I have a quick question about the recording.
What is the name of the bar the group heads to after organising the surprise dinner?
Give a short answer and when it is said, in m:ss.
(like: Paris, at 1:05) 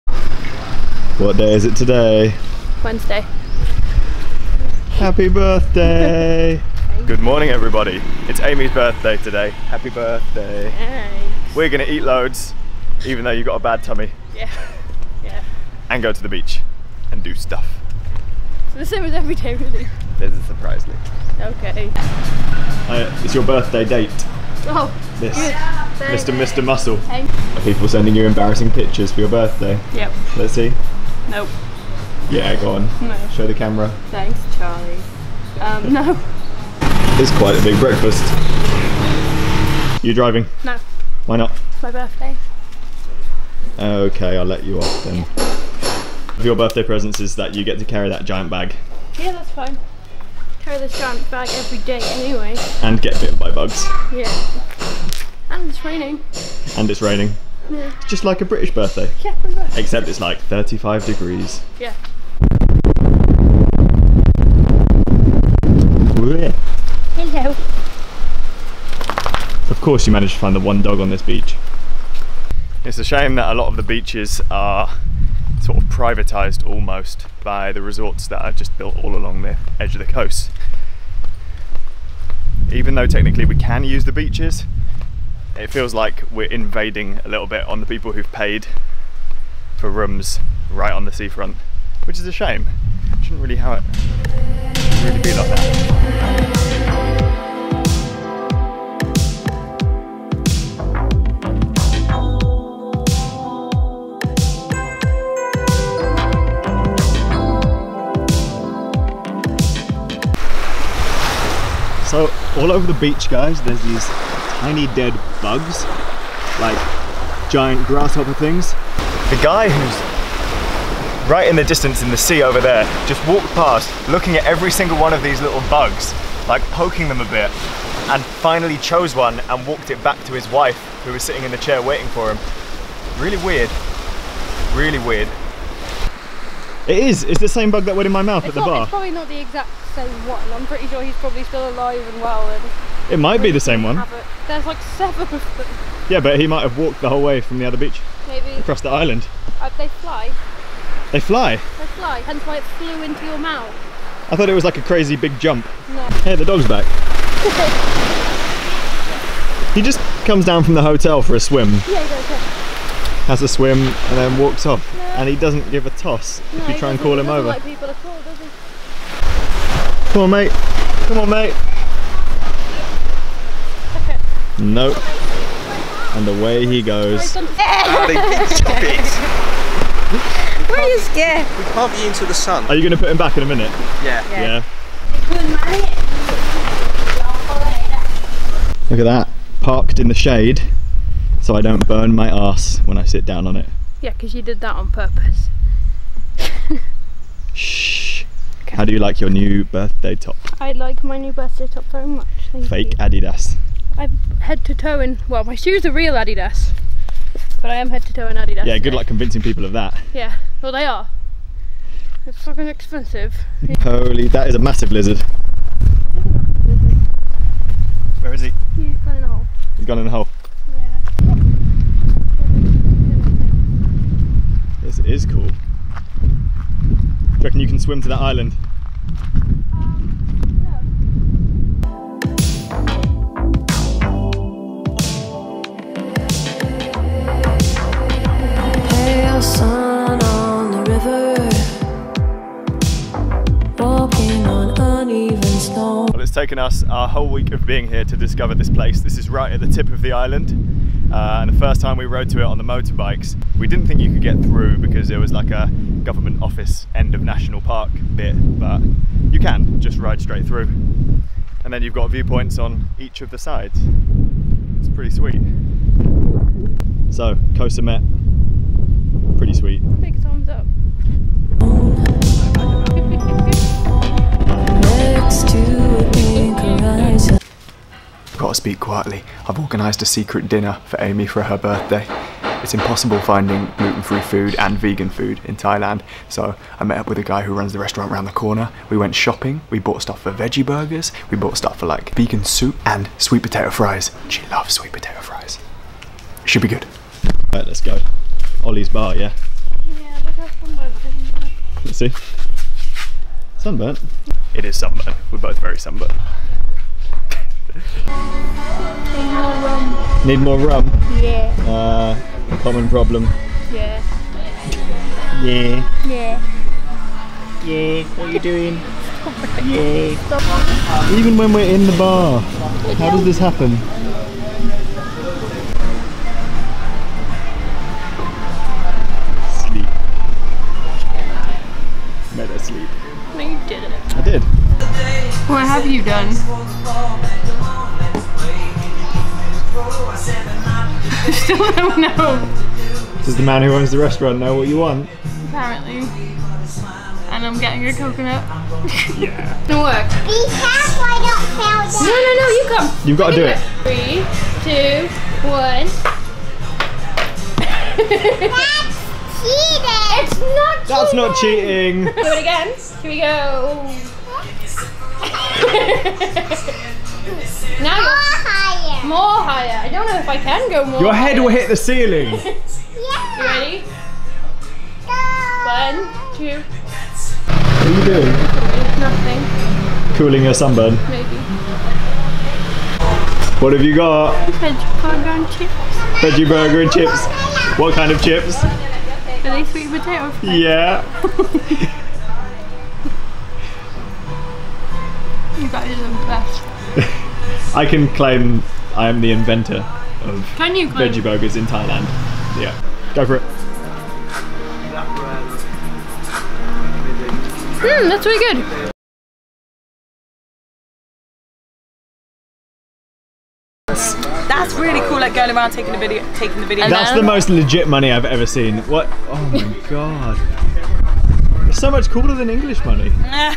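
Ollie's bar, at 4:58.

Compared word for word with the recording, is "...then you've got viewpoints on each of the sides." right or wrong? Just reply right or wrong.
right.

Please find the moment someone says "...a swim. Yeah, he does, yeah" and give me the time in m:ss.
2:41.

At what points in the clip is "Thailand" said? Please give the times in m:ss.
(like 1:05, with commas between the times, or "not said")
4:45, 6:41.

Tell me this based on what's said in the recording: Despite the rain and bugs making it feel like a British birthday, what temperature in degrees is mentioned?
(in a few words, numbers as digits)
35.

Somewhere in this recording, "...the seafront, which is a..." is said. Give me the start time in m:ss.
1:31.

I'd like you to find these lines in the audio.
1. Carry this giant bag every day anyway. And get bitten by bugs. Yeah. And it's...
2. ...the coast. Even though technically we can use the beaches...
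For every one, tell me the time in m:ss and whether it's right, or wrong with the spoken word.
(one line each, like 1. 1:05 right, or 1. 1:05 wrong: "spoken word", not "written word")
1. 0:50 right
2. 1:20 right.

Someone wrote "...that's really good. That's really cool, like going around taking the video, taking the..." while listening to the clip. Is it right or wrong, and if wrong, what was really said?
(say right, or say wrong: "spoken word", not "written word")
right.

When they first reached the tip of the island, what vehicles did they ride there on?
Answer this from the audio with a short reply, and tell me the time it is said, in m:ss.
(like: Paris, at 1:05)
Motorbikes, at 4:12.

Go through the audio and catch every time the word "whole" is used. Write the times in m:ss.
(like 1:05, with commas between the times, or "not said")
2:27, 4:07.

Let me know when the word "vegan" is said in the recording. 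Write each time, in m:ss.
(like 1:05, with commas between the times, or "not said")
4:44, 4:52.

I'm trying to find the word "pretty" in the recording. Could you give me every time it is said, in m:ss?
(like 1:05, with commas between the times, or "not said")
2:20, 4:24, 4:29.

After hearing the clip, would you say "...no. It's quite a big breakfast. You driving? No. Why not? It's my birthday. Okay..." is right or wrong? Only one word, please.
right.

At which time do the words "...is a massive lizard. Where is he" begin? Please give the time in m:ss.
3:34.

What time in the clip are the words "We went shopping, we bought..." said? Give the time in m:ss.
4:48.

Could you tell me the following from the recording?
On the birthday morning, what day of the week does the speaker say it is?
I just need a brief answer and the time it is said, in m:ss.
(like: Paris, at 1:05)
Wednesday, at 0:02.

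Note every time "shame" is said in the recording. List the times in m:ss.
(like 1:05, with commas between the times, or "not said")
1:13, 1:32.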